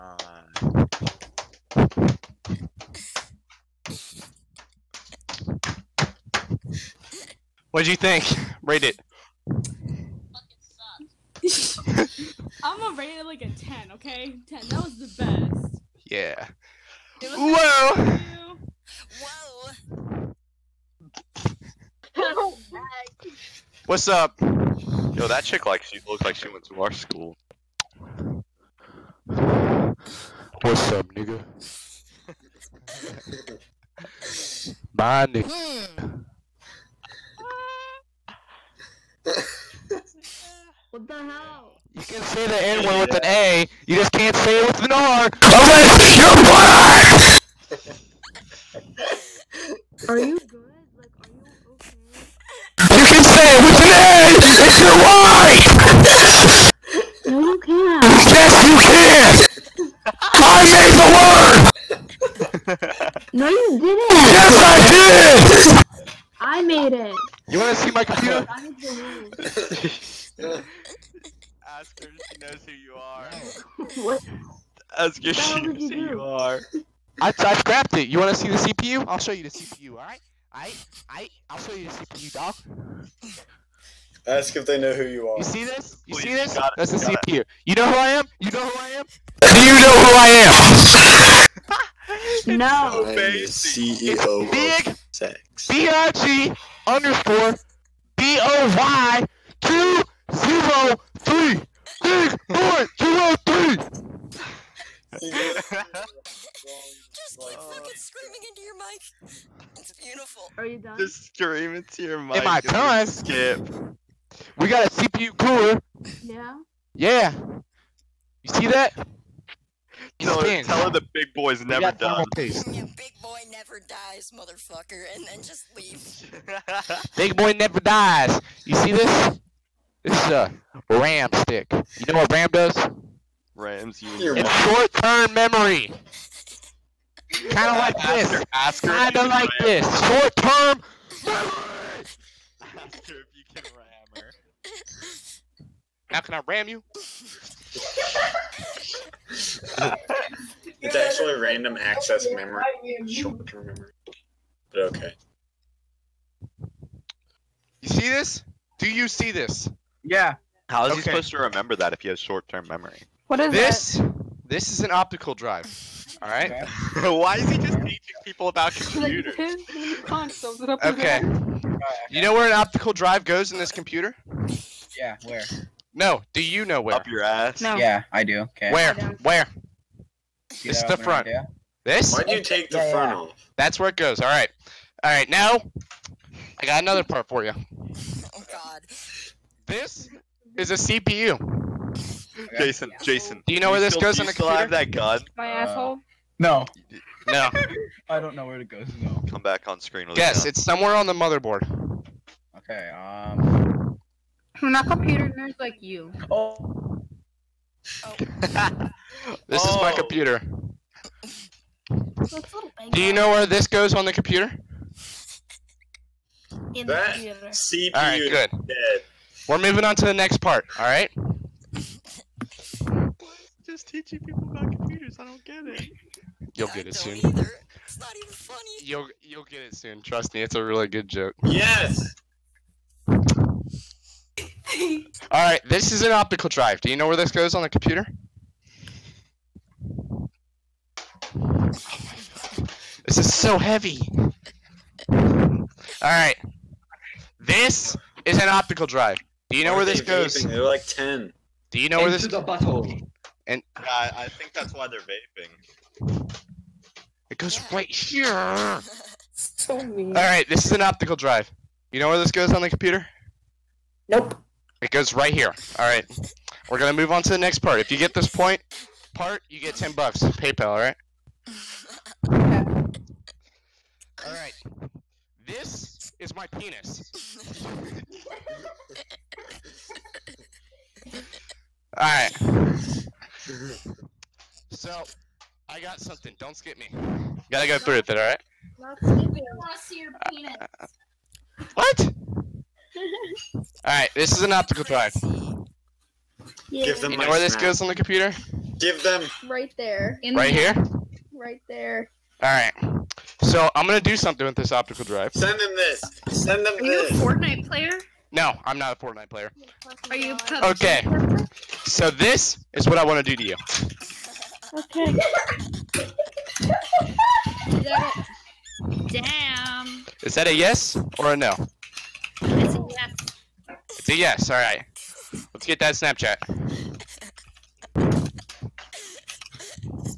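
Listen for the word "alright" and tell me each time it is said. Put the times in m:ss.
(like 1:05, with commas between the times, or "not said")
1:19, 5:24.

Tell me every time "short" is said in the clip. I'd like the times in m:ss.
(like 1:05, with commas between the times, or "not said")
2:14, 2:20, 2:33, 2:42.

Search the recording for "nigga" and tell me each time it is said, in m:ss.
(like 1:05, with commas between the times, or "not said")
0:31, 0:35.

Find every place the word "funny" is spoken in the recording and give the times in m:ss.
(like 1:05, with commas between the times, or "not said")
3:48.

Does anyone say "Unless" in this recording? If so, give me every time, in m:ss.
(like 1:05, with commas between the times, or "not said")
0:45.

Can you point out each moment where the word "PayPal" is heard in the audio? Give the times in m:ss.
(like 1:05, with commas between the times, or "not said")
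4:30.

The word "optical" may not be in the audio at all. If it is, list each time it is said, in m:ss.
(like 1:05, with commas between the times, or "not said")
2:44, 2:52, 3:56, 4:08, 4:20, 4:54, 5:04.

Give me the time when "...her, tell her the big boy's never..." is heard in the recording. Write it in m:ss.
2:00.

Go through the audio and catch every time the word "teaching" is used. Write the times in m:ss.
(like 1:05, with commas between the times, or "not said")
2:47, 3:43.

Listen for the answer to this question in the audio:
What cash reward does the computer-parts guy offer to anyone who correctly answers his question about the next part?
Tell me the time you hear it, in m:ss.
4:29.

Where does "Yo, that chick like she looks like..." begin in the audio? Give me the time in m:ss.
0:24.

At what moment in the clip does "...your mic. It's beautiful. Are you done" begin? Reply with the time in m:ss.
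1:48.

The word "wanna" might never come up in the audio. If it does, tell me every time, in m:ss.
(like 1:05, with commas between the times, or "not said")
1:07, 1:18.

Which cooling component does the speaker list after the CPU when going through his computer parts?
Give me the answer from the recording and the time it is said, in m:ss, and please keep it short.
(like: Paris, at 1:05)
CPU cooler, at 1:54.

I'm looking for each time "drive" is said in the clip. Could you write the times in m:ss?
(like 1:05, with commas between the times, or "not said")
2:45, 2:52, 3:56, 4:08, 4:21, 4:54, 5:05.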